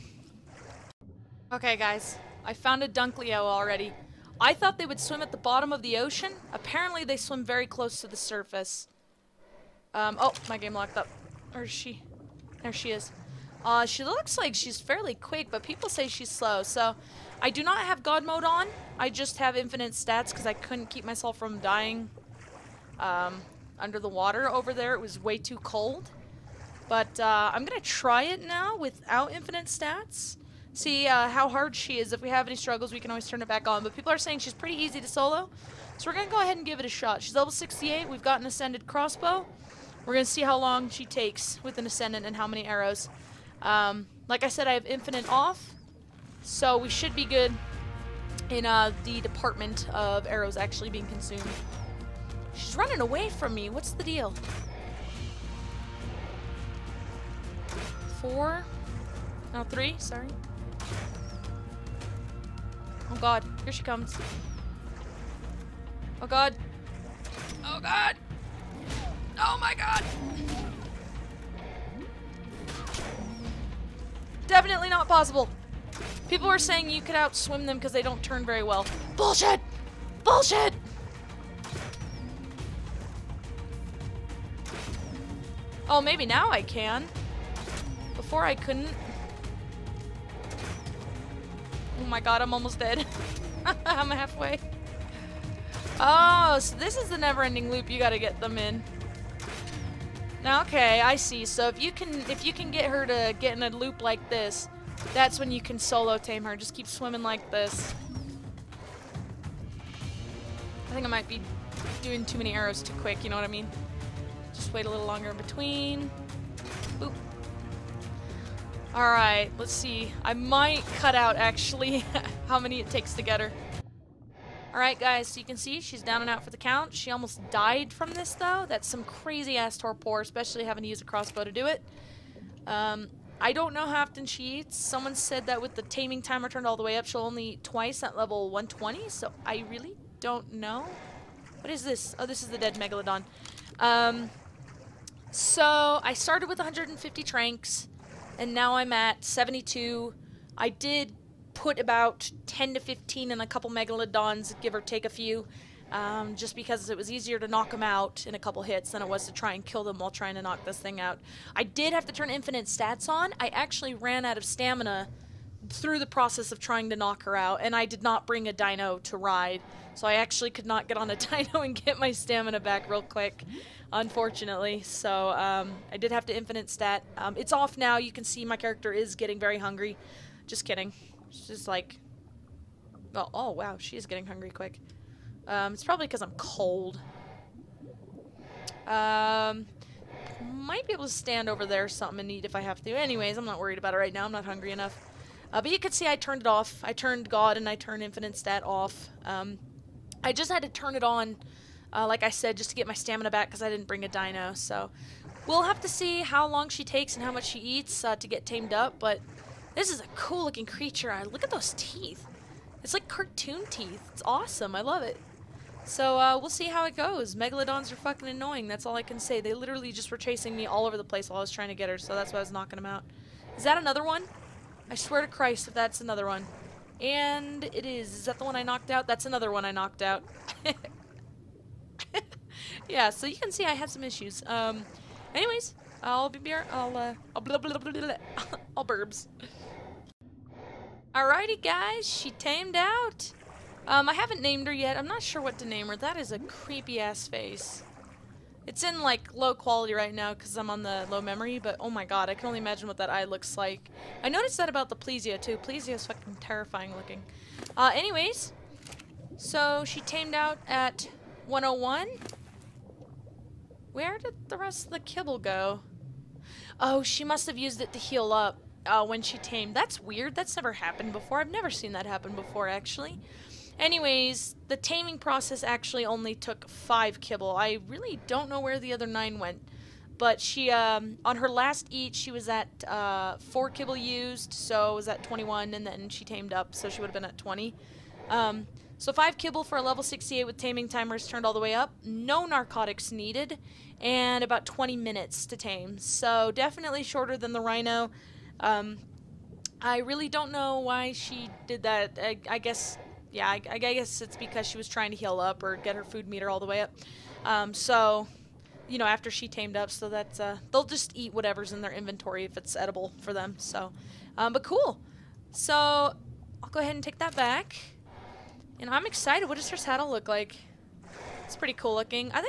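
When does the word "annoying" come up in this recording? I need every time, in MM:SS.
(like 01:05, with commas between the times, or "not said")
03:38.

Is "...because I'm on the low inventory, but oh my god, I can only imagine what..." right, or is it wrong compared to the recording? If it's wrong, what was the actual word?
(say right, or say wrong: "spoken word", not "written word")
wrong: "memory", not "inventory".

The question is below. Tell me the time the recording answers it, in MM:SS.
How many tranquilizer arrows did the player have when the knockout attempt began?
02:26.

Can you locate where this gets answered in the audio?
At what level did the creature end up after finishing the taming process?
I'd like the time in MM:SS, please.
04:21.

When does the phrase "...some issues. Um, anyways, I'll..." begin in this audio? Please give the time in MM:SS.
03:53.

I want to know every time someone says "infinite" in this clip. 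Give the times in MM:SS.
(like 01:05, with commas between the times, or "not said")
00:19, 00:29, 00:44, 02:42, 02:56, 03:18.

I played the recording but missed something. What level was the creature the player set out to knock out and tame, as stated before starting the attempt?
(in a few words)
68.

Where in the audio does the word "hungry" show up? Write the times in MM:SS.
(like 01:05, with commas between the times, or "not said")
02:59, 03:04, 03:14.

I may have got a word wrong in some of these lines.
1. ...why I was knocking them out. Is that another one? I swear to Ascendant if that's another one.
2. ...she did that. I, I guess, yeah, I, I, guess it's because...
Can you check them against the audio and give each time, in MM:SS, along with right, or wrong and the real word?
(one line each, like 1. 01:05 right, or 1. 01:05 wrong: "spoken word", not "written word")
1. 03:42 wrong: "Christ", not "Ascendant"
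2. 05:01 right.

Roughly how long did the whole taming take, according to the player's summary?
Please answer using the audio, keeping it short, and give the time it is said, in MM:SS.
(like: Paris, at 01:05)
20 minutes, at 04:54.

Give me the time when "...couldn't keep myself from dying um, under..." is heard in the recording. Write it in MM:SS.
00:20.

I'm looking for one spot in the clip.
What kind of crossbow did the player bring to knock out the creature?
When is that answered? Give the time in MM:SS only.
00:38.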